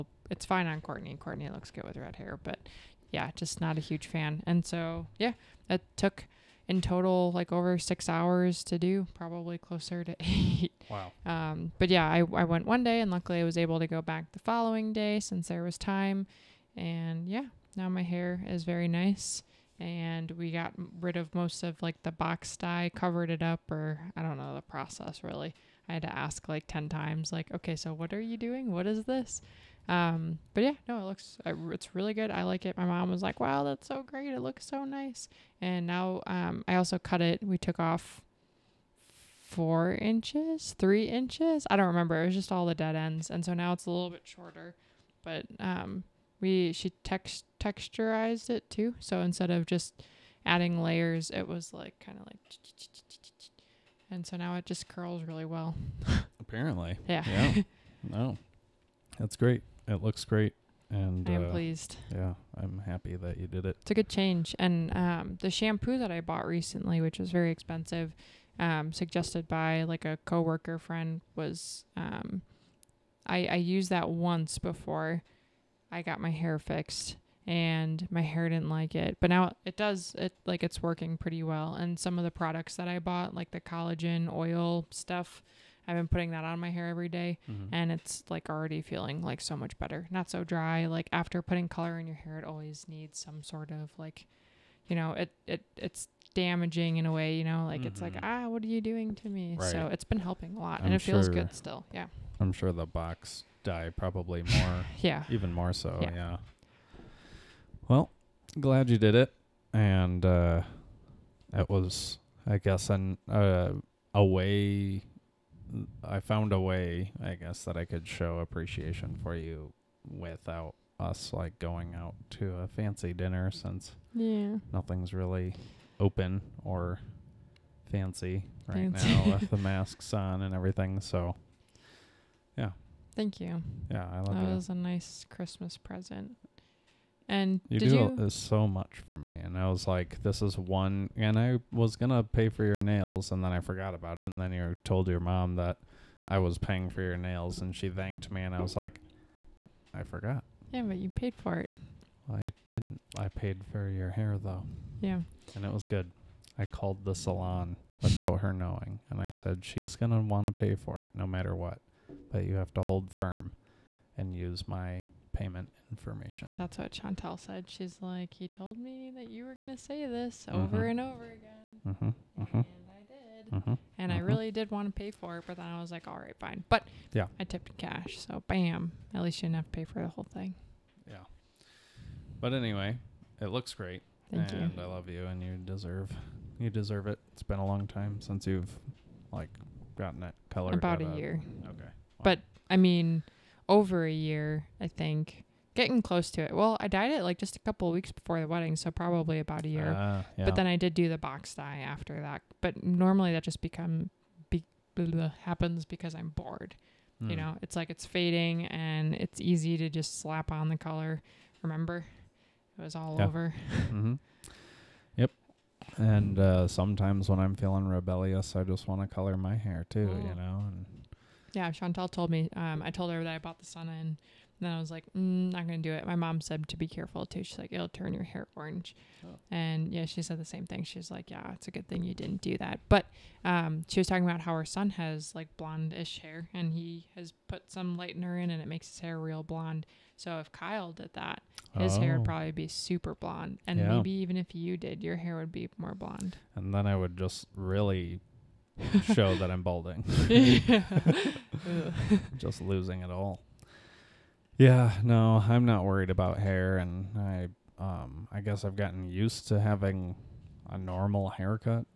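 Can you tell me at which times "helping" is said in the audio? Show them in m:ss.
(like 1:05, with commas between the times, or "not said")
1:40.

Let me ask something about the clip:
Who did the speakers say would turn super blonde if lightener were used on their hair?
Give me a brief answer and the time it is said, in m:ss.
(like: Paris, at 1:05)
Kyle, at 4:00.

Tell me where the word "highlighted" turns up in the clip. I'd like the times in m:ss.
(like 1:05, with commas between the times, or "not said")
not said.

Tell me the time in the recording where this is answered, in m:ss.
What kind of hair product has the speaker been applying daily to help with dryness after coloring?
1:23.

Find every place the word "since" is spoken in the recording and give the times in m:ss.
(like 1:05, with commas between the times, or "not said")
0:15, 2:03, 3:08.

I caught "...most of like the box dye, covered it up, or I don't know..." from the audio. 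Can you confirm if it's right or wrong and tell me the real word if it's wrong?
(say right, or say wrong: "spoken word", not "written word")
right.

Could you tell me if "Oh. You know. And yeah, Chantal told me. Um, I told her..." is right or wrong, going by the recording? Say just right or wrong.
right.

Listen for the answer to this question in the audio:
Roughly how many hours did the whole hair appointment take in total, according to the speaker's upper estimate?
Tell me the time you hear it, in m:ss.
0:10.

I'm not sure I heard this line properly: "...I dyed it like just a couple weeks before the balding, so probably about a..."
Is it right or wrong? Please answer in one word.
wrong.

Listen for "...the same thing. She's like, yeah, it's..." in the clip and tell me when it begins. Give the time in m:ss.
3:50.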